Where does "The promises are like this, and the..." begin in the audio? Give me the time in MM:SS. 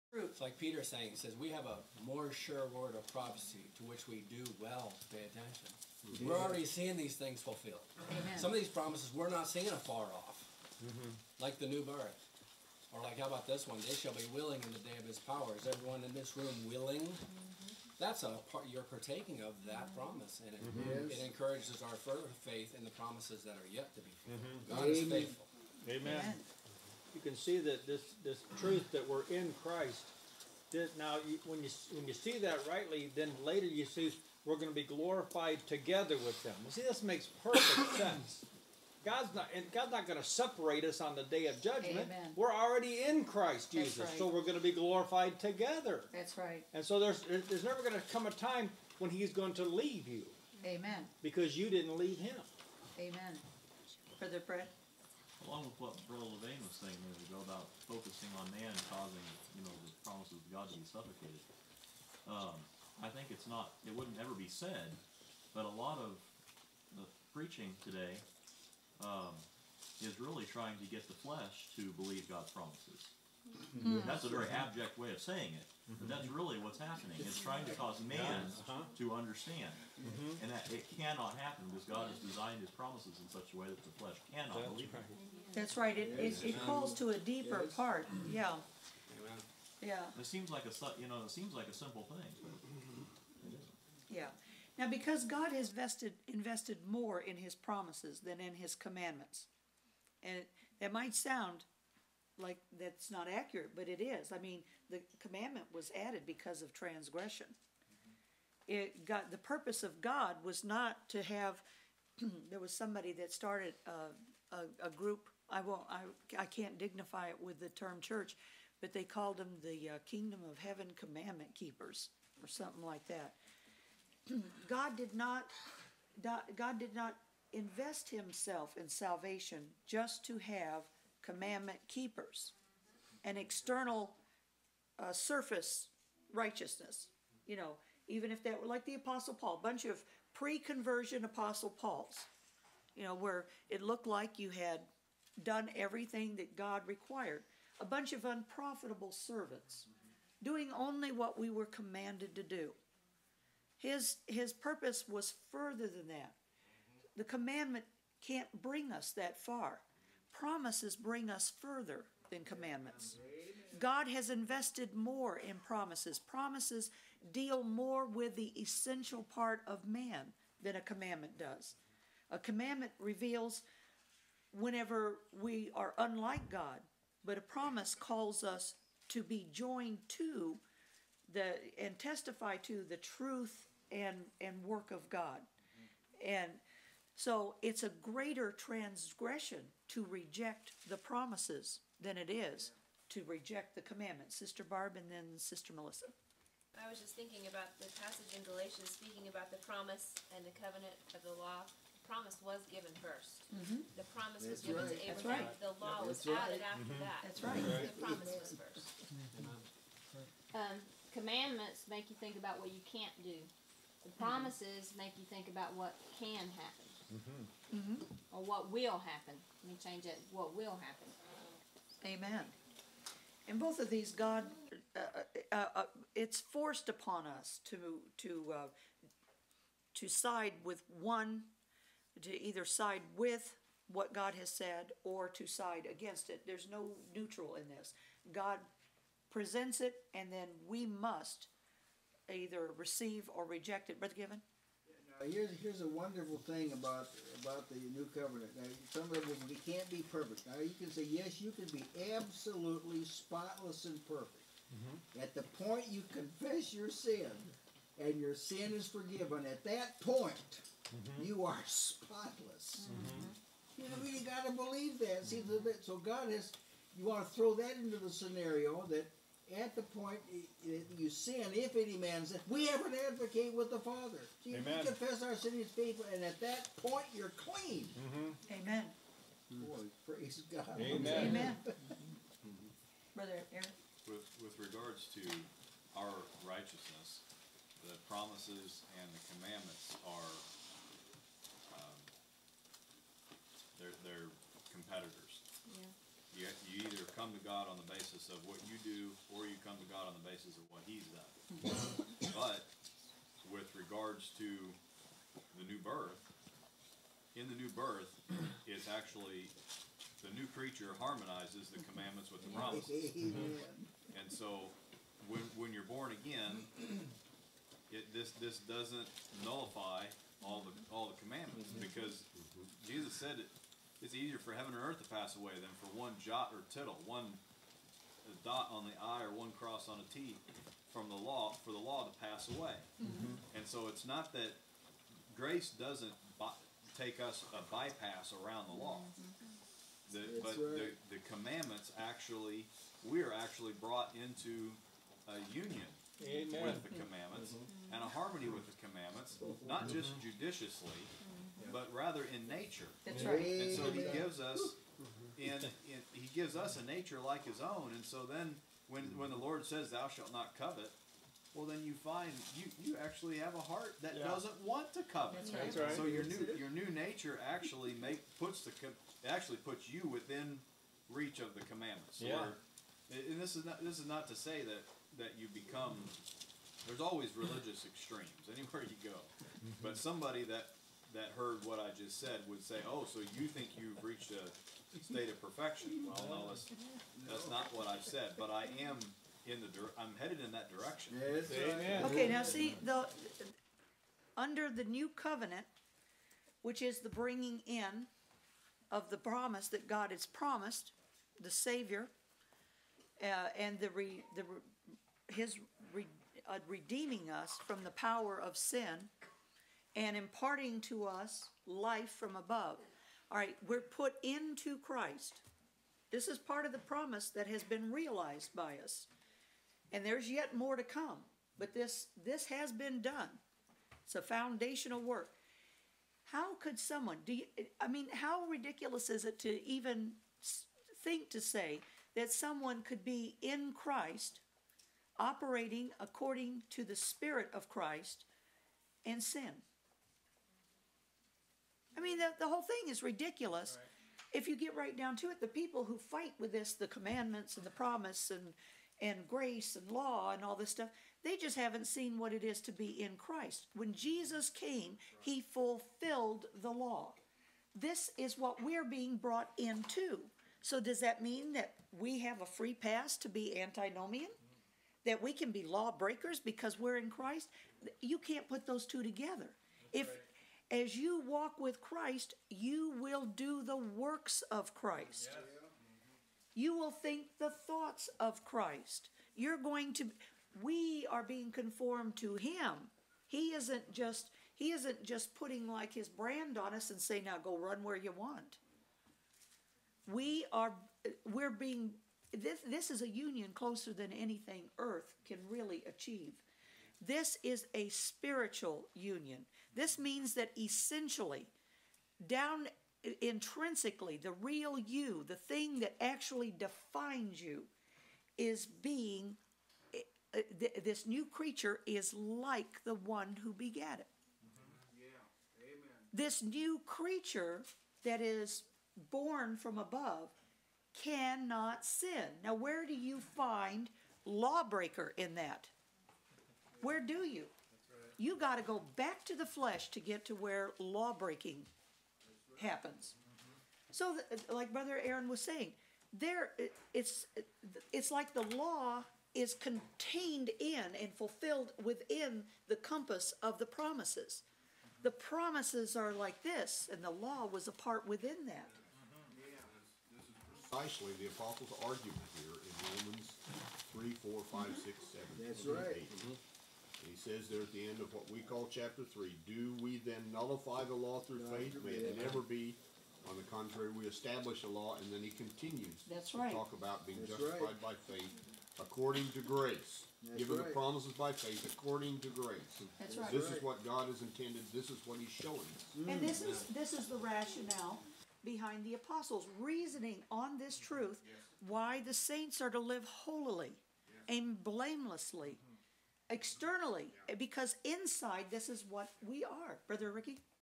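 09:05.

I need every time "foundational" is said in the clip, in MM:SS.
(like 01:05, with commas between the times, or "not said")
07:04.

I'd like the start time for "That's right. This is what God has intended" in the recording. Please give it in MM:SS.
09:32.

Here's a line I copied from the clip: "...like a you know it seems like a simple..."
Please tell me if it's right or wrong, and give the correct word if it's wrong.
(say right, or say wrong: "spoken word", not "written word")
right.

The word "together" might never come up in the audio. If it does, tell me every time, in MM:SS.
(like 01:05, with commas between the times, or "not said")
00:35, 00:45, 07:49.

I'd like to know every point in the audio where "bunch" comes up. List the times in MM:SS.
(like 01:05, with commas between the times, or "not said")
02:19, 02:27.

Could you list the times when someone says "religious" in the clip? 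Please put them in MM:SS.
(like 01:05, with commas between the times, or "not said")
06:17.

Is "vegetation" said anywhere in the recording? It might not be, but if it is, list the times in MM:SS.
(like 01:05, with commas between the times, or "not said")
not said.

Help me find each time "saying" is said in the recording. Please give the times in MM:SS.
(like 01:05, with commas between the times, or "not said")
00:00, 01:15, 08:55.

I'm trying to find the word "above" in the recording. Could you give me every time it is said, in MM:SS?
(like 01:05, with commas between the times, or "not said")
06:52, 08:39.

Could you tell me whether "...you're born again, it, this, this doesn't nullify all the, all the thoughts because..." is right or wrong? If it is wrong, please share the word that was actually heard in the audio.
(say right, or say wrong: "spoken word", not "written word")
wrong: "commandments", not "thoughts".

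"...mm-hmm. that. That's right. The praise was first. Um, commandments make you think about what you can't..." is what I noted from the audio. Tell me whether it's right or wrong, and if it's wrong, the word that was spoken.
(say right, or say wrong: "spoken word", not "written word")
wrong: "promise", not "praise".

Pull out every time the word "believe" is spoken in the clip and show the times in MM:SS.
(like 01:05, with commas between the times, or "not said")
01:11, 01:24, 04:24.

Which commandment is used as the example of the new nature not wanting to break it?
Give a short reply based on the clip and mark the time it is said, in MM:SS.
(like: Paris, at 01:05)
Thou shalt not covet, at 05:59.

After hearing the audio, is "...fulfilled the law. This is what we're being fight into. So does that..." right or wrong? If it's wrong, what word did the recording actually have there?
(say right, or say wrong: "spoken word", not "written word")
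wrong: "brought", not "fight".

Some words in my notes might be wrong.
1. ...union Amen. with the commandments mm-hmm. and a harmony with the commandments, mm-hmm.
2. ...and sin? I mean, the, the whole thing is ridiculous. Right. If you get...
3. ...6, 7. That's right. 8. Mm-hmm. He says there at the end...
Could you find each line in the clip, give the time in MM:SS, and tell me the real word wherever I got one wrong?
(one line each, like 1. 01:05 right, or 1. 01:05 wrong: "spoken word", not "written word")
1. 05:45 right
2. 07:19 right
3. 09:14 right.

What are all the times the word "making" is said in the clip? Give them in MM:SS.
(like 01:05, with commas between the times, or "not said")
not said.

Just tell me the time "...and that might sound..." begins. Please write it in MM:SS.
01:40.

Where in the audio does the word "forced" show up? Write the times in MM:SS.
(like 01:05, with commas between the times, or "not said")
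03:46.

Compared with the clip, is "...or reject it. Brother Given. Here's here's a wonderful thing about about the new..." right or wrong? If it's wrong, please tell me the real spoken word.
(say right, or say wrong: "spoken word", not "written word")
right.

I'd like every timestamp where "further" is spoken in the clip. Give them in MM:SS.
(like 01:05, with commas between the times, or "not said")
00:22, 02:35, 02:41.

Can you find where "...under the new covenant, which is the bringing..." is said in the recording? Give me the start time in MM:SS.
06:34.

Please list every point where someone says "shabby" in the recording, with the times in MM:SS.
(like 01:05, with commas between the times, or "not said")
not said.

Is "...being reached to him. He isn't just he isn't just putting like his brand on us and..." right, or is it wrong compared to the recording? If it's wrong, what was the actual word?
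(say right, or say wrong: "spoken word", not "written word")
wrong: "conformed", not "reached".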